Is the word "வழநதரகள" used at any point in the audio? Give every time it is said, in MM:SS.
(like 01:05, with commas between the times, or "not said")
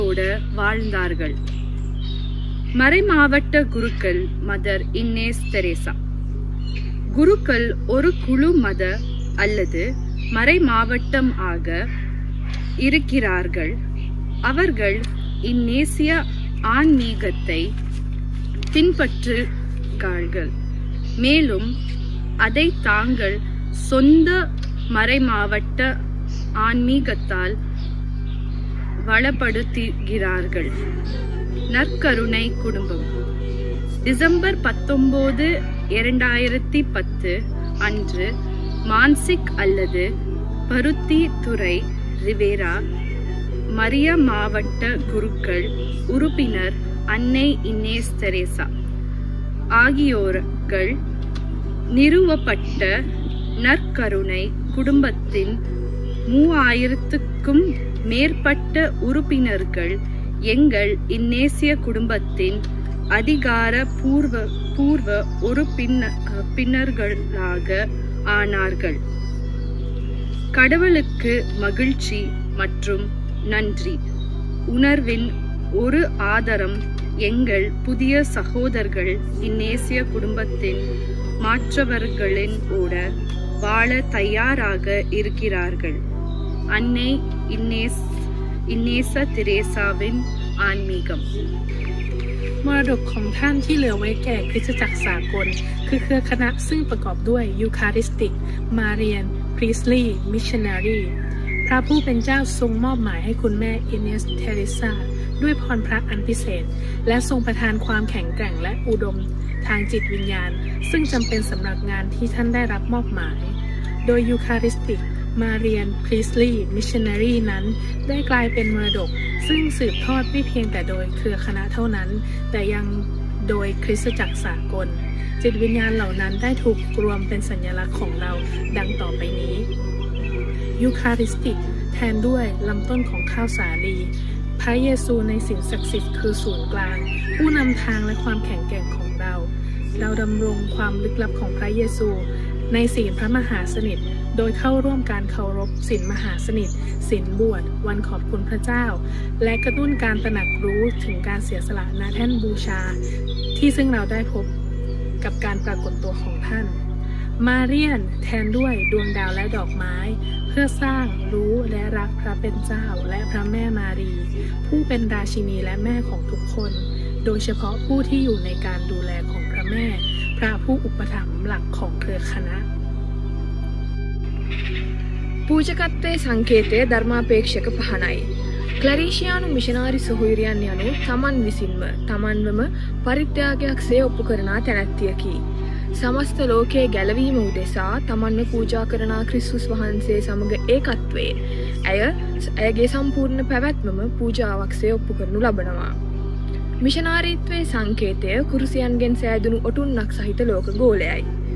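00:00.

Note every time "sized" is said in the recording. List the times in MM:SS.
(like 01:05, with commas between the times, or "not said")
not said.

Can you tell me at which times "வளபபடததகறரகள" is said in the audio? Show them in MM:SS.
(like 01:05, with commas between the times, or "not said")
00:29.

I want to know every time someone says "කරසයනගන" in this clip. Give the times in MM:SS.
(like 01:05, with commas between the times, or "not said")
03:18.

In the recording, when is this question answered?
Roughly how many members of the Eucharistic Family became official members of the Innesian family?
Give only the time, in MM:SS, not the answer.
00:56.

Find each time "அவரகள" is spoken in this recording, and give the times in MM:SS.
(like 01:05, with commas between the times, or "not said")
00:14.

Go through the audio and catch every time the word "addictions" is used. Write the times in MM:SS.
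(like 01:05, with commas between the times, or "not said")
not said.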